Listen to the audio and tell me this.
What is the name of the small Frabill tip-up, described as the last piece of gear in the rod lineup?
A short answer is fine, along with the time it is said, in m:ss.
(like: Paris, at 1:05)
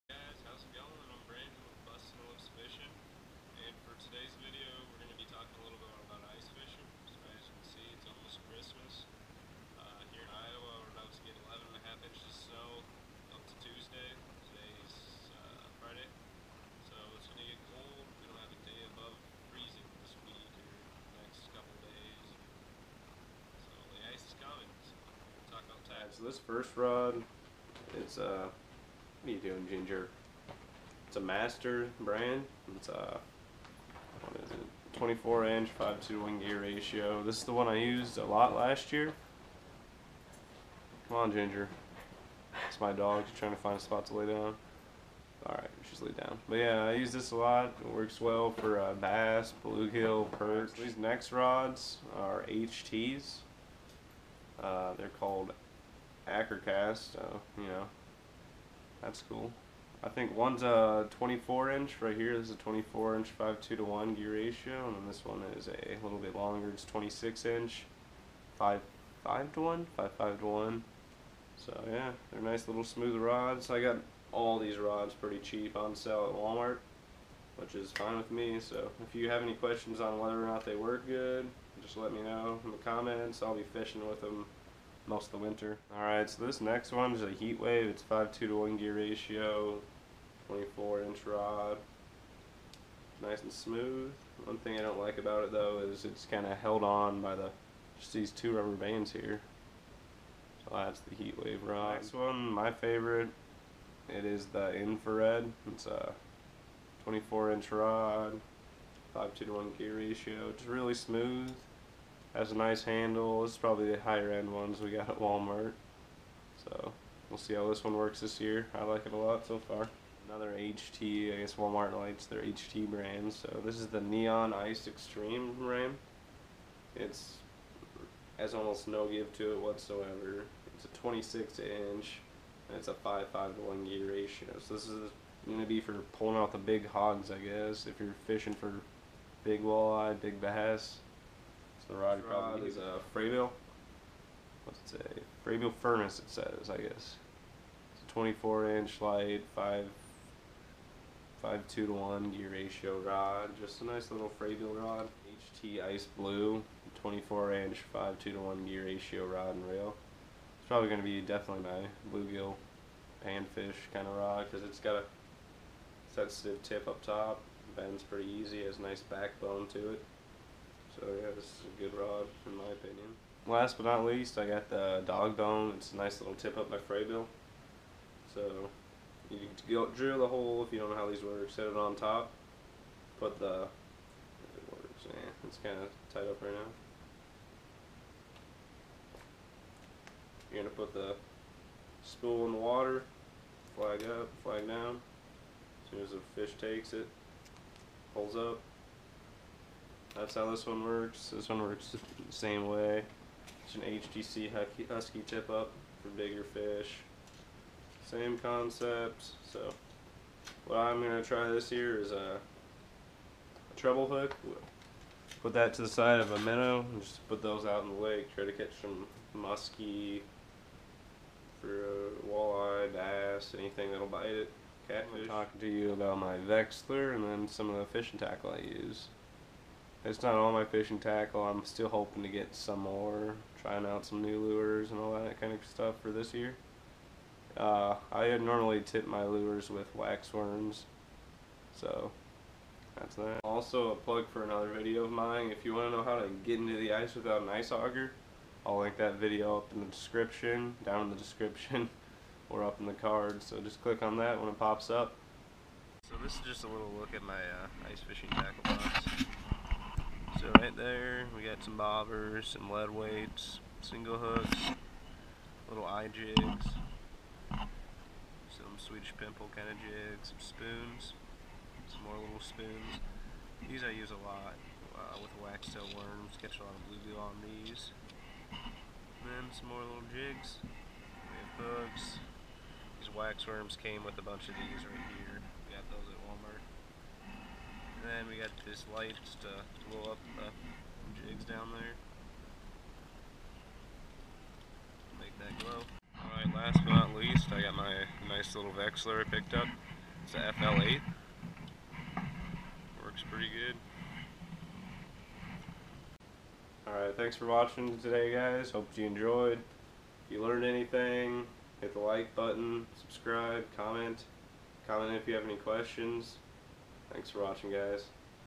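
Dog bone, at 2:55.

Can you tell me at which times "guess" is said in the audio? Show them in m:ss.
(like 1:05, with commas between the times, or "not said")
2:01, 2:17, 2:26.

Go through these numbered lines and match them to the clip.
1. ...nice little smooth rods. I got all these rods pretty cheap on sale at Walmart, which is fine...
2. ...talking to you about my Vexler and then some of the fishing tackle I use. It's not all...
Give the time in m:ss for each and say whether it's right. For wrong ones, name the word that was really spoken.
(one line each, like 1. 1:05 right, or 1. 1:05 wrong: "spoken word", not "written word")
1. 1:12 right
2. 3:45 right.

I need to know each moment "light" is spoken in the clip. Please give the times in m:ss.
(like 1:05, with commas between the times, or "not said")
2:01, 2:29, 4:48.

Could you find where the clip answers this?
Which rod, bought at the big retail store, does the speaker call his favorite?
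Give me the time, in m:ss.
1:44.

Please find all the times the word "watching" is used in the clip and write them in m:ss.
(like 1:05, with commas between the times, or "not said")
5:07, 5:17.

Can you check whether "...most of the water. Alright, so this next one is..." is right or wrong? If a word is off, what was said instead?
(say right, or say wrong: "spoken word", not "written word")
wrong: "winter", not "water".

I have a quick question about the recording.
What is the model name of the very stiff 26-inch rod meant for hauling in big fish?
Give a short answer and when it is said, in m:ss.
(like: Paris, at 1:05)
Neon Ice Extreme, at 2:03.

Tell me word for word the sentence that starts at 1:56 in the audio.
So we'll see how this one works this year.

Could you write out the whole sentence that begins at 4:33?
These I use a lot uh, with wax tail worms, catch a lot of bluegill on these.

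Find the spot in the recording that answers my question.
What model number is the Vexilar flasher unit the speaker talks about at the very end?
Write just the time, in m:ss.
5:00.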